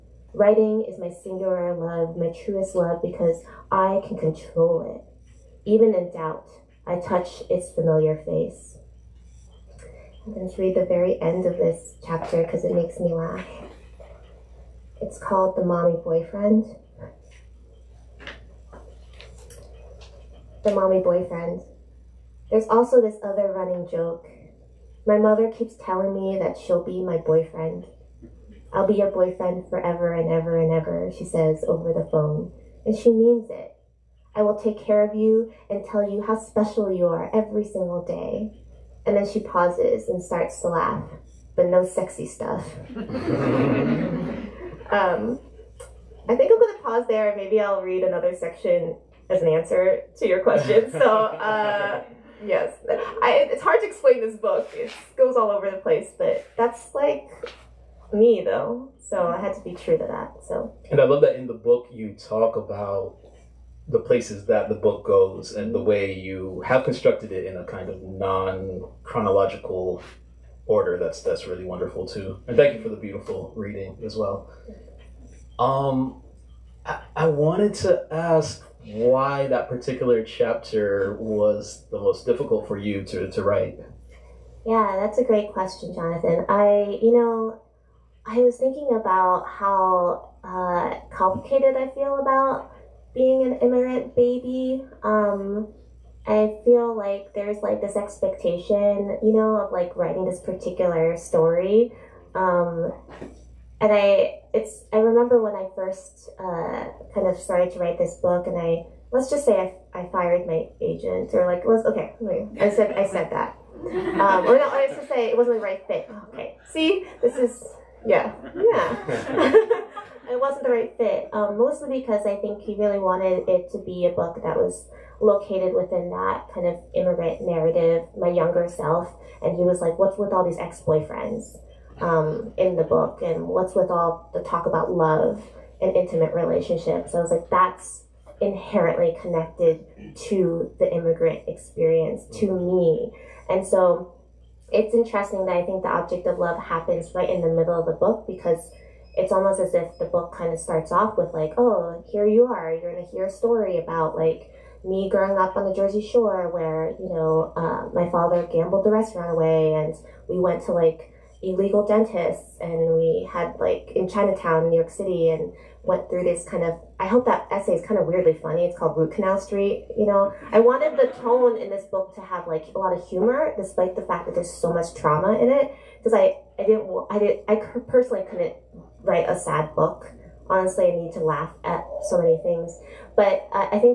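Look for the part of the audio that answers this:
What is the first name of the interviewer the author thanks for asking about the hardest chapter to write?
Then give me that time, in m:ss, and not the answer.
1:25.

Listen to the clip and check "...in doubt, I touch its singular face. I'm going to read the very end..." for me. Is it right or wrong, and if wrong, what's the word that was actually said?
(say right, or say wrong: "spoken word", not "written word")
wrong: "familiar", not "singular".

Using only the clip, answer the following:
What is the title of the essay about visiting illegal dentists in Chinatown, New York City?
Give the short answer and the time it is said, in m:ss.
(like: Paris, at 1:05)
Root Canal Street, at 2:48.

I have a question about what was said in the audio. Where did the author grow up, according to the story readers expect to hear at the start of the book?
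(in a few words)
Jersey Shore.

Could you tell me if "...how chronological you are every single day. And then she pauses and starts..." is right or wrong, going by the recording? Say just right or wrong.
wrong.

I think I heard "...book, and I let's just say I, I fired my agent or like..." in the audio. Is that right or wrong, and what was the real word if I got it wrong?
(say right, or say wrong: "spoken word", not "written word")
right.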